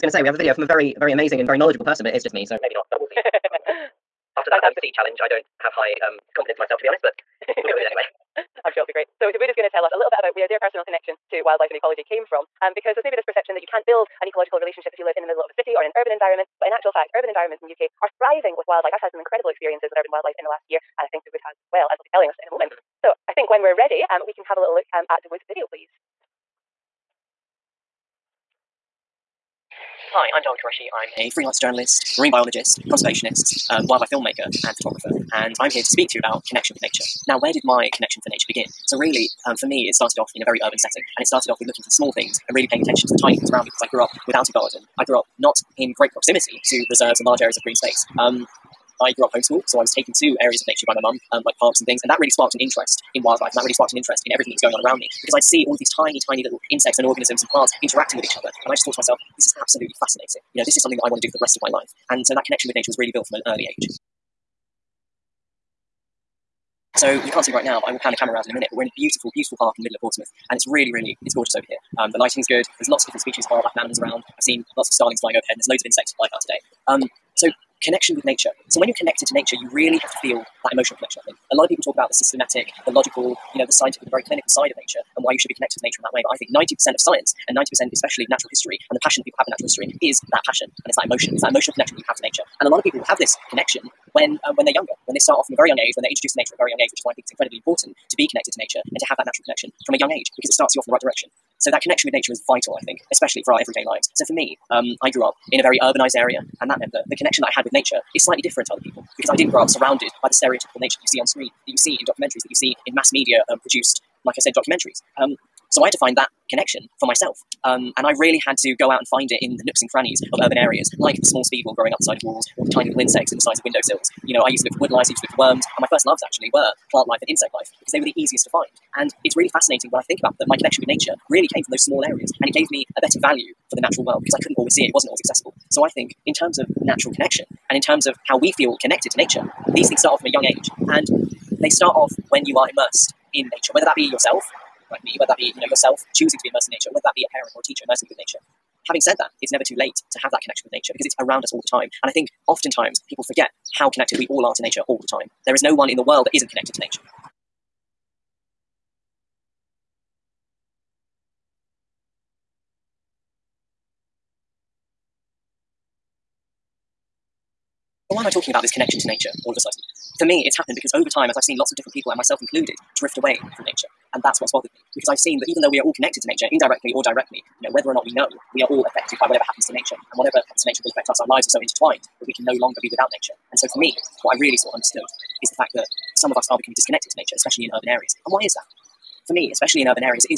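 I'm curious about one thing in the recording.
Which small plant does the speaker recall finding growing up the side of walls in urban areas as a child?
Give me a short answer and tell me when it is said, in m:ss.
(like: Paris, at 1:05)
Speedwell, at 2:01.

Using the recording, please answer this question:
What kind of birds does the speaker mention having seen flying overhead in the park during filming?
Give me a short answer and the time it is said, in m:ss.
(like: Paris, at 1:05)
Starlings, at 1:14.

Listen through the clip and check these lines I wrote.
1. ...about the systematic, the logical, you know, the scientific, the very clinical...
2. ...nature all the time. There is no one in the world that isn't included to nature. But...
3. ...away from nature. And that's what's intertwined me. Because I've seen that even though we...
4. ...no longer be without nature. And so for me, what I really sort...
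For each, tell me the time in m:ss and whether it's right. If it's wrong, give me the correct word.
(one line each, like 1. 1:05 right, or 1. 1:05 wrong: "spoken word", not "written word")
1. 1:21 right
2. 2:34 wrong: "connected", not "included"
3. 2:53 wrong: "bothered", not "intertwined"
4. 3:02 right.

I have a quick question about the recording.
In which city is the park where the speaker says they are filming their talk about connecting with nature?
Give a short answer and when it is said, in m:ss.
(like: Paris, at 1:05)
Portsmouth, at 1:10.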